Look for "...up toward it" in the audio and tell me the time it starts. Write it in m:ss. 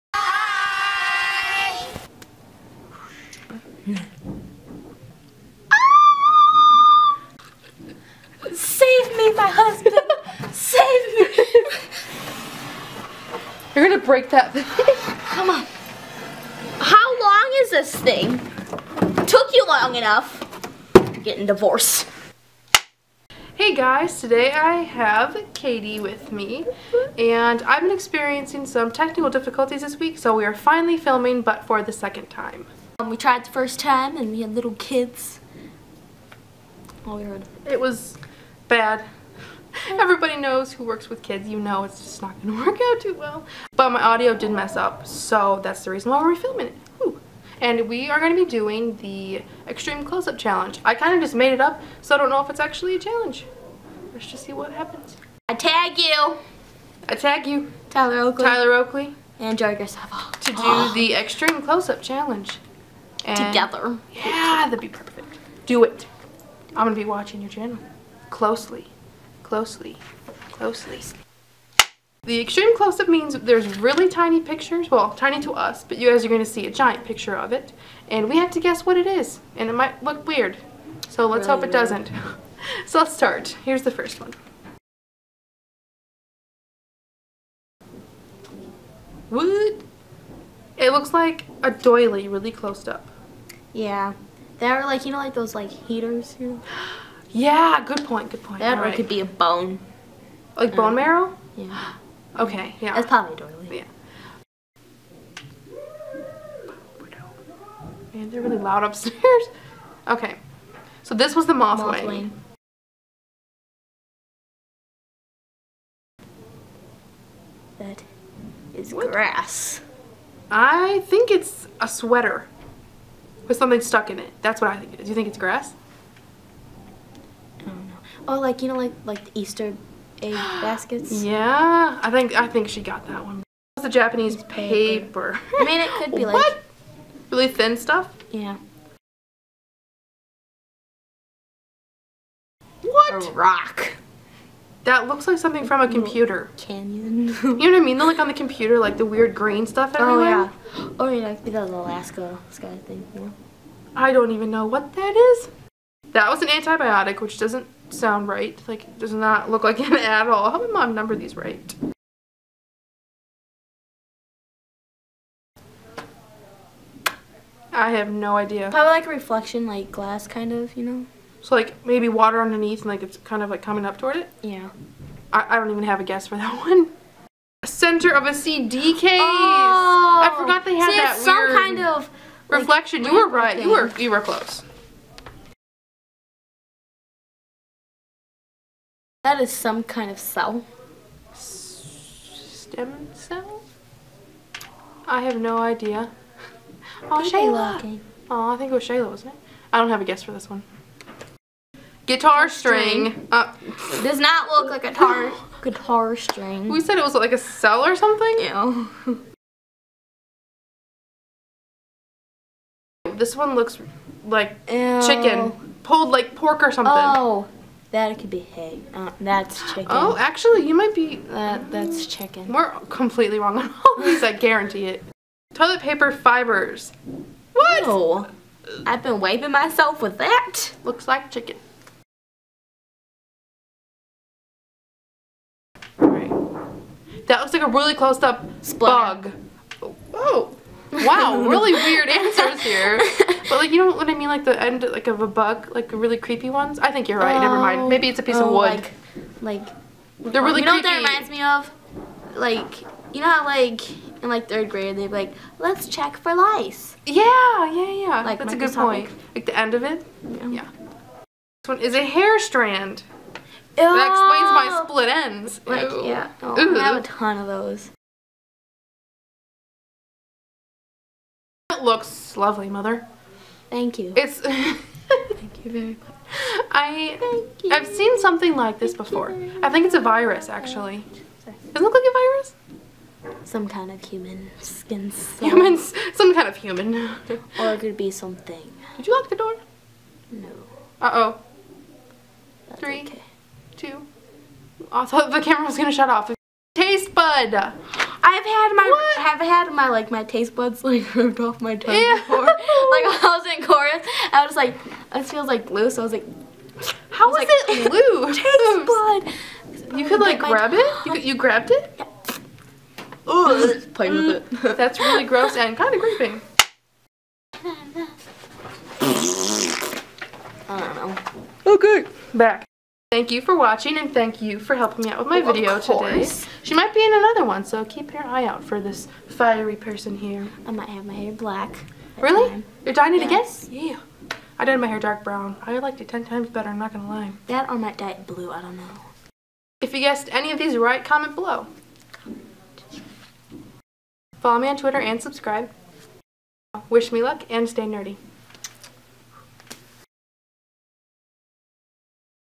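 2:53.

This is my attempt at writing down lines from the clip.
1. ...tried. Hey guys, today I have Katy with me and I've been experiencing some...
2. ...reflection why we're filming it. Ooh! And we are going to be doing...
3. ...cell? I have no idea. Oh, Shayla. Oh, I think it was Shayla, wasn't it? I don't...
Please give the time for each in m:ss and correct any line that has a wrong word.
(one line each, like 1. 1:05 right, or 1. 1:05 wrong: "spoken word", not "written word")
1. 0:21 wrong: "divorced", not "tried"
2. 0:45 wrong: "reason", not "reflection"
3. 3:13 right.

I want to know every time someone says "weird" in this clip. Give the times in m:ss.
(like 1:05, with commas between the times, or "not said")
1:20, 2:29, 3:01, 4:01.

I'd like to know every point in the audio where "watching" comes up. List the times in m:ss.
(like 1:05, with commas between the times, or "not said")
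1:07, 5:23.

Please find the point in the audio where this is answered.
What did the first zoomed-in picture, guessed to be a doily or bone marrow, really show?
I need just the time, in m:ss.
1:51.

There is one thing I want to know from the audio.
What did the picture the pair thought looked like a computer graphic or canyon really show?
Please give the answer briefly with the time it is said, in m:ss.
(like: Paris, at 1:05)
An antibiotic, at 2:36.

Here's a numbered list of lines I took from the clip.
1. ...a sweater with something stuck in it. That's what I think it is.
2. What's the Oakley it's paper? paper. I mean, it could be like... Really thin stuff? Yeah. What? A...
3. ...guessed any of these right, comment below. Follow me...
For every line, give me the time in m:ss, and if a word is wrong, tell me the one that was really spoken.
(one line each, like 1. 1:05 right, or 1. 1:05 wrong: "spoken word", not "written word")
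1. 2:01 right
2. 2:13 wrong: "Japanese", not "Oakley"
3. 5:39 right.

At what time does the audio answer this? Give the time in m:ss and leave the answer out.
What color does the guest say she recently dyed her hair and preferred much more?
5:34.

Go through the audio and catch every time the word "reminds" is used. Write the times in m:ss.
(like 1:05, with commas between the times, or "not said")
4:10.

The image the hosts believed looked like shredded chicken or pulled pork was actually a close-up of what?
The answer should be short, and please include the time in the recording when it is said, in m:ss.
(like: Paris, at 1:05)
Toilet paper fibers, at 3:45.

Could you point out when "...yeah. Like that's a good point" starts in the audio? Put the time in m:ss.
4:17.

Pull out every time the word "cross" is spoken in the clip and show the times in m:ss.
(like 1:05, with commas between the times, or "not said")
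not said.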